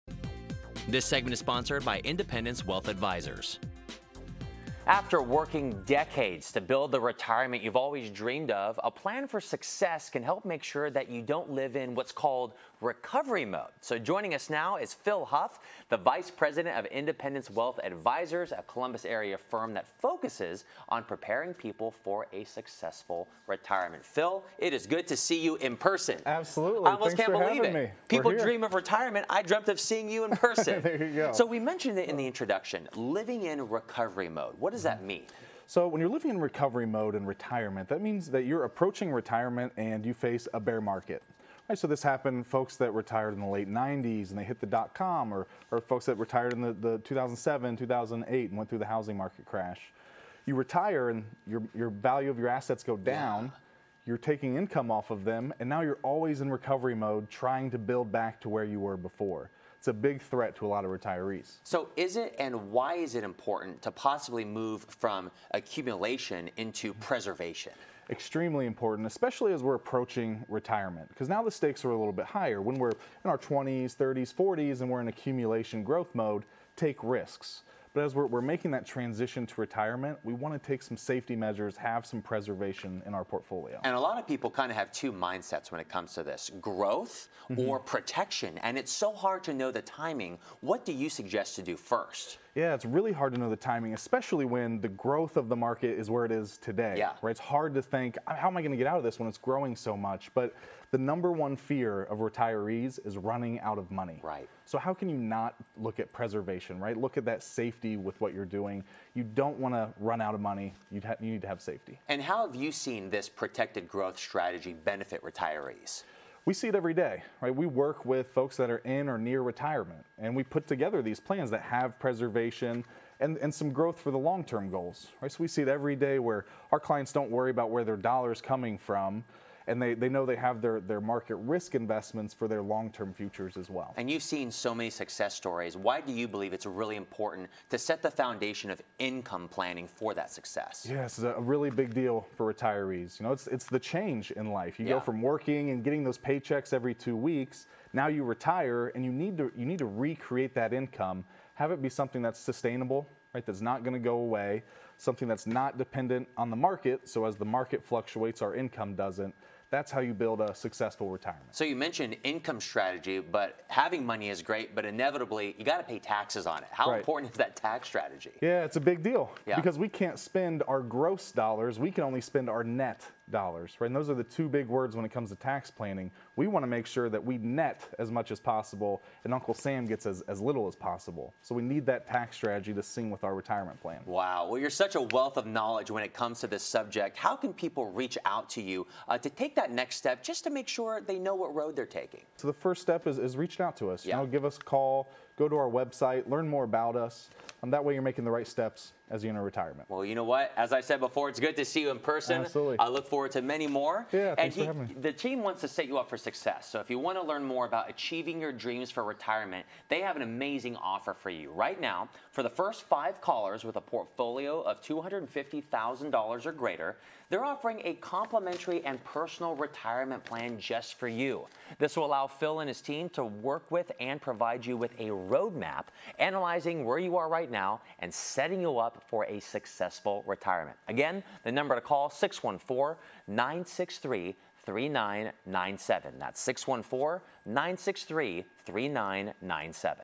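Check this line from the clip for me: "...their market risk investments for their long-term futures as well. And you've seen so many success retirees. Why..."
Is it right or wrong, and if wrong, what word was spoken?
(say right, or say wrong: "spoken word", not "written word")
wrong: "stories", not "retirees".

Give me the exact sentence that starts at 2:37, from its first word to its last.
So as the market fluctuates, our income doesn't.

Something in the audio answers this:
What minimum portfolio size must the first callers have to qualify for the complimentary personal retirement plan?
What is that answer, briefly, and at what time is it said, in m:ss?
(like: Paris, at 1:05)
$250,000, at 3:34.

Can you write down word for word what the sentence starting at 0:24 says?
Phil, it is good to see you in person.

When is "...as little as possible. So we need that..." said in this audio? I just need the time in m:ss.
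3:00.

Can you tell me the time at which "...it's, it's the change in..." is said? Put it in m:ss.
2:23.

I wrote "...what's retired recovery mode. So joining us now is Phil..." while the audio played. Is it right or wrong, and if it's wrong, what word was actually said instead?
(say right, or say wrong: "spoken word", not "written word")
wrong: "called", not "retired".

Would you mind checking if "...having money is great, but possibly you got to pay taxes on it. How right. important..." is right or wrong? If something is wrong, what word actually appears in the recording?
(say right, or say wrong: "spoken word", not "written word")
wrong: "inevitably", not "possibly".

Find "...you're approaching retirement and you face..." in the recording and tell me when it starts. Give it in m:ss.
0:38.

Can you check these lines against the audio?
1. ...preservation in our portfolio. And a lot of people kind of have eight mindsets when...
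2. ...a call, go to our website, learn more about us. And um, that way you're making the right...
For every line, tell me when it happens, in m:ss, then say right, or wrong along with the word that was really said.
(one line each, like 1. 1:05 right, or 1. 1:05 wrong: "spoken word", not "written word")
1. 1:22 wrong: "two", not "eight"
2. 3:14 right.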